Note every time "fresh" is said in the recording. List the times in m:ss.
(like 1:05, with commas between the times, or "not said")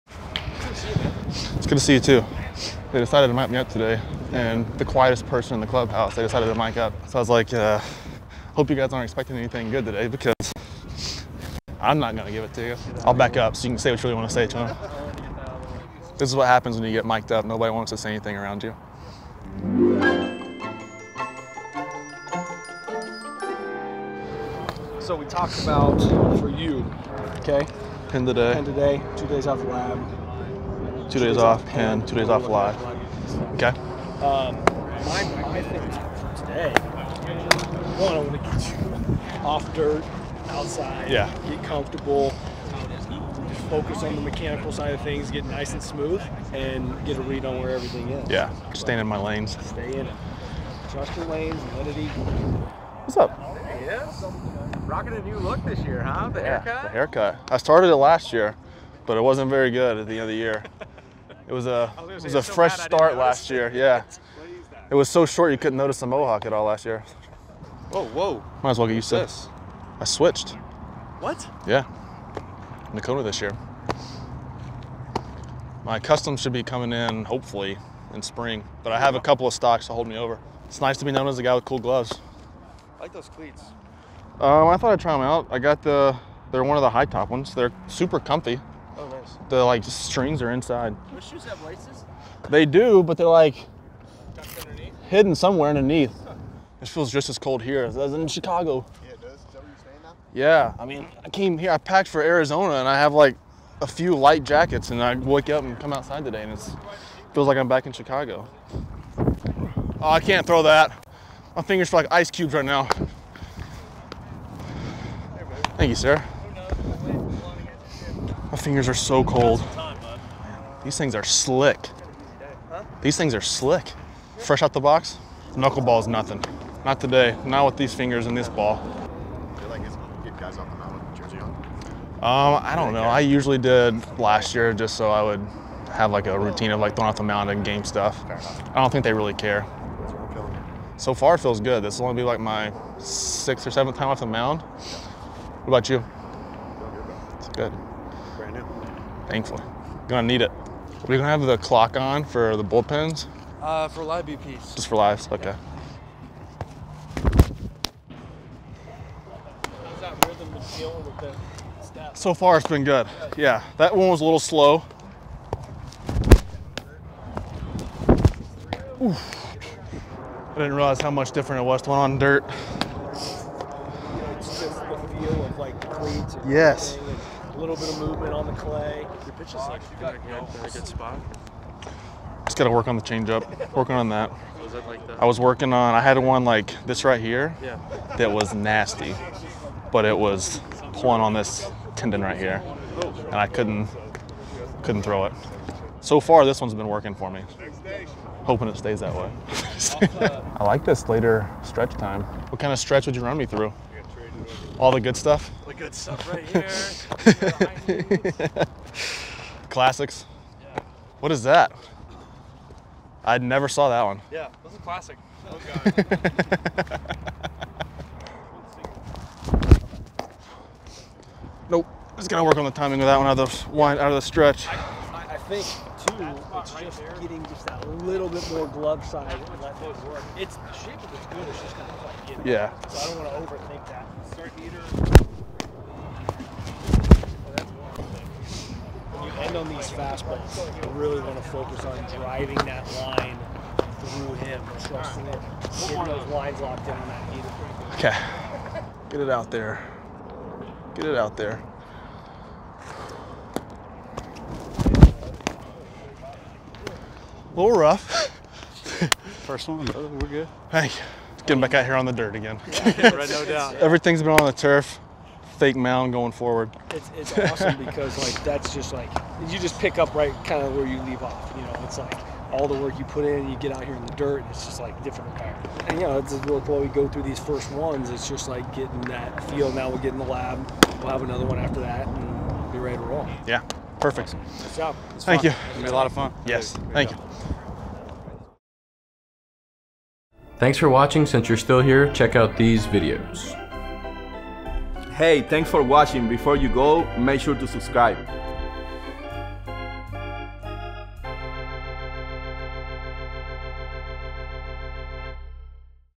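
1:02, 2:04.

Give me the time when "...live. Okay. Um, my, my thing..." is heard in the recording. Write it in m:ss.
0:32.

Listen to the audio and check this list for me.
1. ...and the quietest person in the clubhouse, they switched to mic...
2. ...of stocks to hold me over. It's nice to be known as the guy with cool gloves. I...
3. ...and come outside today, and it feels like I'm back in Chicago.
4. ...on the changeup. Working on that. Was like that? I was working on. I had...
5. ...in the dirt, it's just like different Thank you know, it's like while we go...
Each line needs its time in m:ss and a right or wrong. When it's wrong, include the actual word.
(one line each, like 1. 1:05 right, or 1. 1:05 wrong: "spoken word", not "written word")
1. 0:04 wrong: "decided", not "switched"
2. 1:19 right
3. 1:45 right
4. 3:02 right
5. 4:33 wrong: "And", not "Thank".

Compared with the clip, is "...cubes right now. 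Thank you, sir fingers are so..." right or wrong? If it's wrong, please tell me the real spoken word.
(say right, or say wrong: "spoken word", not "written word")
right.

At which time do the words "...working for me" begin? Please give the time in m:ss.
3:16.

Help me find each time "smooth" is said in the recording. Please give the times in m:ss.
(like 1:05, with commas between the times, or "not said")
0:45.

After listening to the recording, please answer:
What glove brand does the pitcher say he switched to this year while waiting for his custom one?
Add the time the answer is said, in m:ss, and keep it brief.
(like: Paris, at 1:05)
Nokona, at 1:12.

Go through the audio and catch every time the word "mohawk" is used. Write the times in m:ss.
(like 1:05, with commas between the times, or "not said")
1:06.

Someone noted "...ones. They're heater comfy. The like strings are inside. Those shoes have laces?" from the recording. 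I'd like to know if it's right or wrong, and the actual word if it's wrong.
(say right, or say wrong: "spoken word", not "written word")
wrong: "super", not "heater".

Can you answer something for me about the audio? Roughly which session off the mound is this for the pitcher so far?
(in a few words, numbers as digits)
sixth or seventh.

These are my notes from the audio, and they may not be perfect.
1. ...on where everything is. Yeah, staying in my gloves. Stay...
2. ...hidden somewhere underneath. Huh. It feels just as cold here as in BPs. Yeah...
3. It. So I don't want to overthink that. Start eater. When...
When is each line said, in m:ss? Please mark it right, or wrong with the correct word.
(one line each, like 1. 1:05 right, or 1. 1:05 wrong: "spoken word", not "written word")
1. 0:47 wrong: "lanes", not "gloves"
2. 1:35 wrong: "Chicago", not "BPs"
3. 3:52 right.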